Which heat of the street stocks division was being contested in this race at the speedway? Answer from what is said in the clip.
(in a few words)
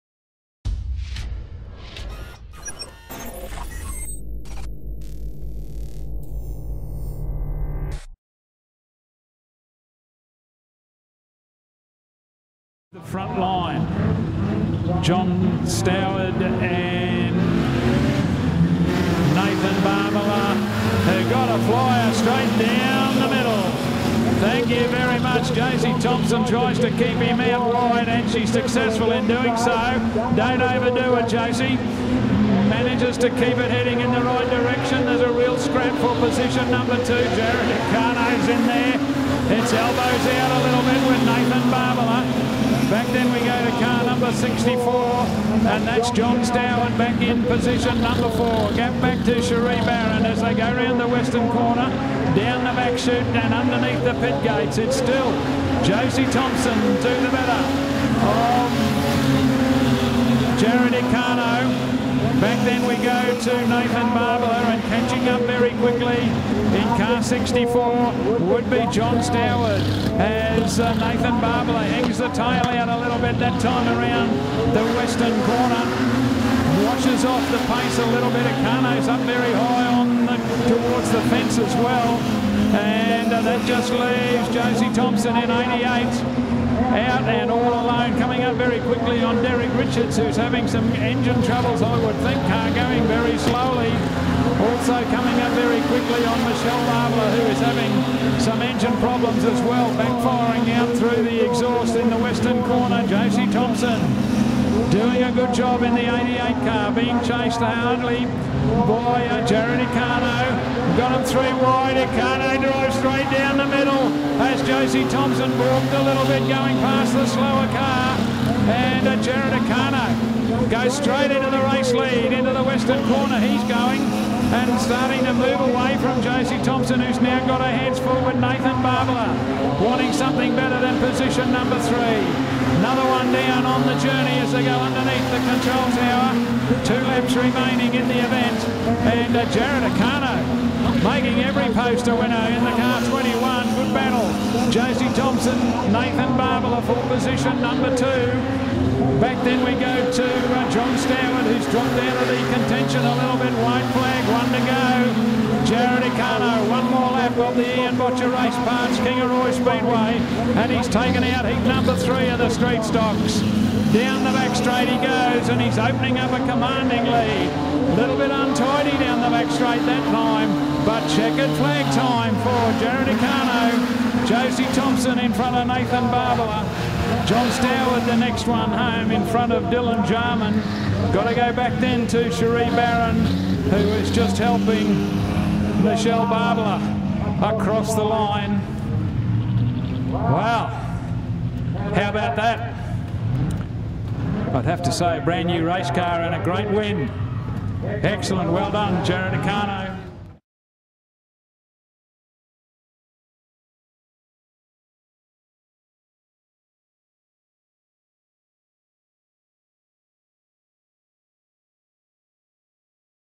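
Heat 3.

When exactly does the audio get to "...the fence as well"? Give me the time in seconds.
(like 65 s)
81 s.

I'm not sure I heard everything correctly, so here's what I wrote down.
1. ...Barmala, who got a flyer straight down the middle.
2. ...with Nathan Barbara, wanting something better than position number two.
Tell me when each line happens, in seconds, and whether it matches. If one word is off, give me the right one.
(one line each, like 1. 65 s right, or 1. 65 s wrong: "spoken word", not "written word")
1. 19 s right
2. 128 s wrong: "three", not "two".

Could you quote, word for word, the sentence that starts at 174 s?
Josie in front of Nathan Barbara.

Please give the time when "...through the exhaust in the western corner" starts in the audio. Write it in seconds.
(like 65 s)
100 s.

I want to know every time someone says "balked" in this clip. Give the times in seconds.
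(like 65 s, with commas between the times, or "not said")
115 s.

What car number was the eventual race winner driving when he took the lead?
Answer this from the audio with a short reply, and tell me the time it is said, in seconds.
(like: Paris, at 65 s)
21, at 143 s.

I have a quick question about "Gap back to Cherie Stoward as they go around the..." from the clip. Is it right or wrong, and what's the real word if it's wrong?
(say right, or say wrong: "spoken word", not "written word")
wrong: "Barron", not "Stoward".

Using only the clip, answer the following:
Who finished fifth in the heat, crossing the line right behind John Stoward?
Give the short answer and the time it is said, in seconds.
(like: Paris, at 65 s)
Dylan Jarman, at 179 s.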